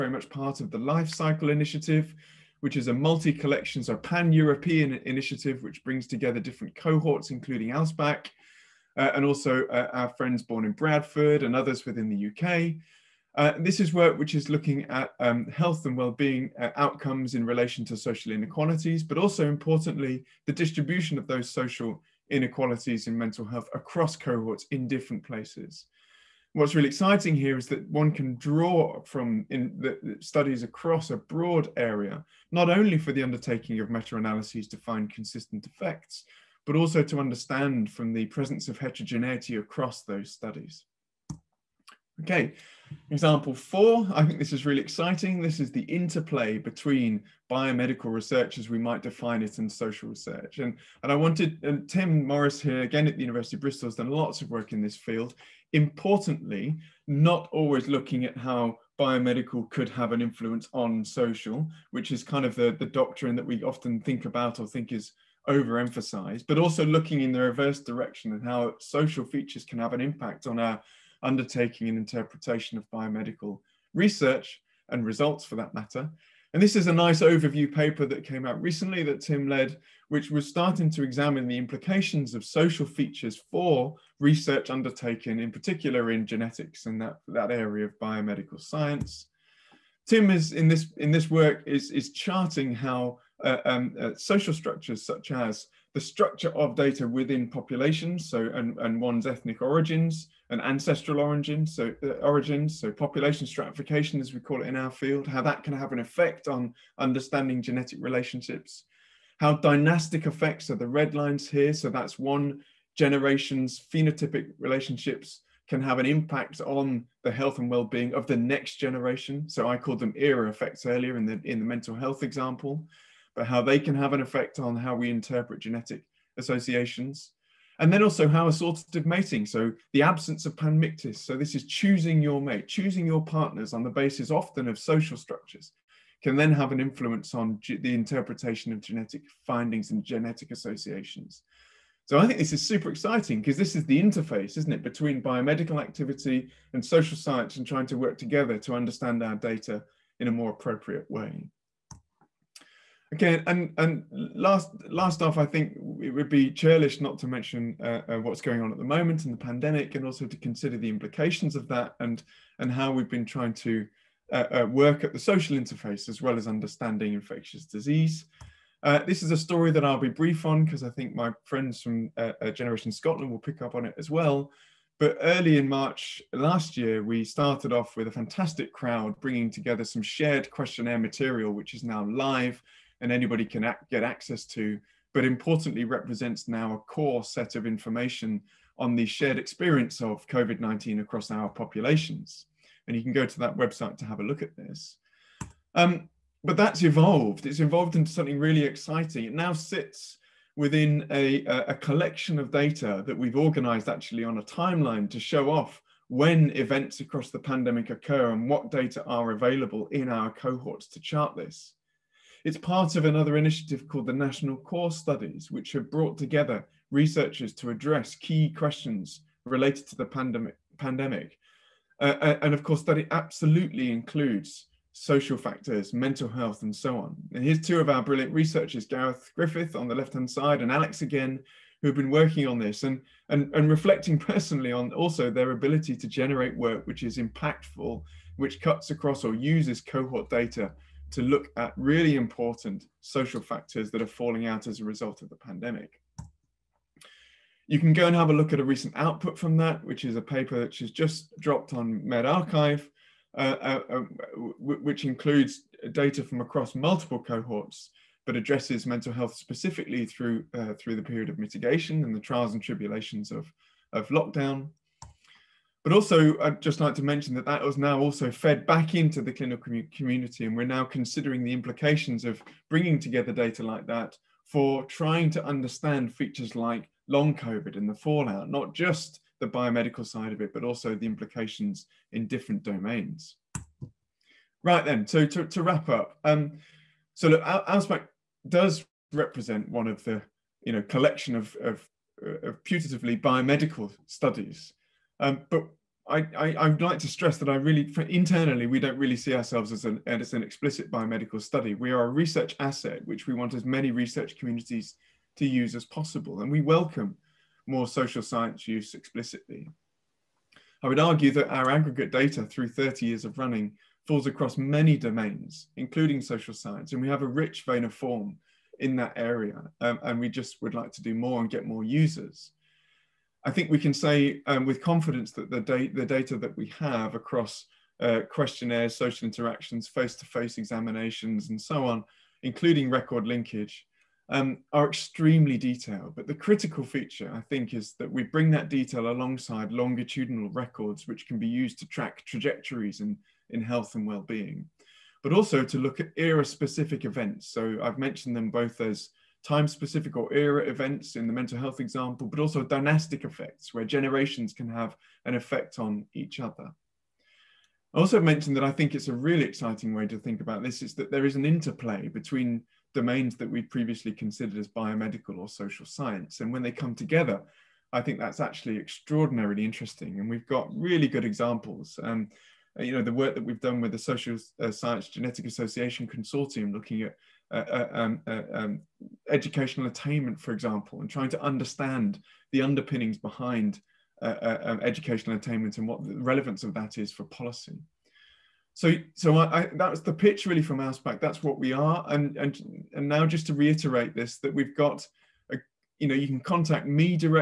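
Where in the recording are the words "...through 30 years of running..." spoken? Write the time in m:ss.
5:12.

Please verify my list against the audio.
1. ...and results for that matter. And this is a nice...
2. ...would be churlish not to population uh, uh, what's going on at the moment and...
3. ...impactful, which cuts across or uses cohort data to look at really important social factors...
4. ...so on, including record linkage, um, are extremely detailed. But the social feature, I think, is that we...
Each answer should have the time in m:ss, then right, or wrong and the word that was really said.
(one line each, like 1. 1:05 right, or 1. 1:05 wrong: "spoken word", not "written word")
1. 1:14 right
2. 2:36 wrong: "mention", not "population"
3. 3:57 right
4. 5:31 wrong: "critical", not "social".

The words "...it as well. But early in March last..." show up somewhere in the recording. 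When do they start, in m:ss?
2:53.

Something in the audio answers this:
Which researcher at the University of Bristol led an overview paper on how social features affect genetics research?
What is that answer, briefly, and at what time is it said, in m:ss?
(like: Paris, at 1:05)
Tim Morris, at 0:51.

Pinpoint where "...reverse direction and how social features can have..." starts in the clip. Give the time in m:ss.
1:07.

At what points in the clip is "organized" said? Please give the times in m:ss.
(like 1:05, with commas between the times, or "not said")
3:23.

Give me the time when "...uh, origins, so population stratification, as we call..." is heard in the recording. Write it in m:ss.
1:42.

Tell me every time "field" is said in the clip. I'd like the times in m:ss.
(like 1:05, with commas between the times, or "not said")
0:54, 1:44.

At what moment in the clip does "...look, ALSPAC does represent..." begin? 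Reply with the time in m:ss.
4:47.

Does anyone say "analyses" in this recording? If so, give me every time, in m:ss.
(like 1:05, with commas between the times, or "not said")
0:33.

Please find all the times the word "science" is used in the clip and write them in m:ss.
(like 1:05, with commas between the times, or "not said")
1:28, 2:27, 5:08, 5:16, 6:05, 6:14.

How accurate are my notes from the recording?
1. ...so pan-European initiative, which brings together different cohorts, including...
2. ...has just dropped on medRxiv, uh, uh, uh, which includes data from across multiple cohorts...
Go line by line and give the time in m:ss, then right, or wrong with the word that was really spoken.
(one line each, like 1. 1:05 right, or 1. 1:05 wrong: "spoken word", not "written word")
1. 0:03 right
2. 4:10 right.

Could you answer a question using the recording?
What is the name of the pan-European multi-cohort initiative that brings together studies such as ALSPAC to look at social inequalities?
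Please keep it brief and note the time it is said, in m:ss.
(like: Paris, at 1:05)
Life Cycle Initiative, at 0:00.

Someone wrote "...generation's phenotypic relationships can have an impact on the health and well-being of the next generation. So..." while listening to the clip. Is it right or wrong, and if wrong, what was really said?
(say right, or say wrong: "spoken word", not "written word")
right.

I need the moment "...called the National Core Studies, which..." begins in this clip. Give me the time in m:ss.
3:33.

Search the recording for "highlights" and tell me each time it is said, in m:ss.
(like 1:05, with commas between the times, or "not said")
not said.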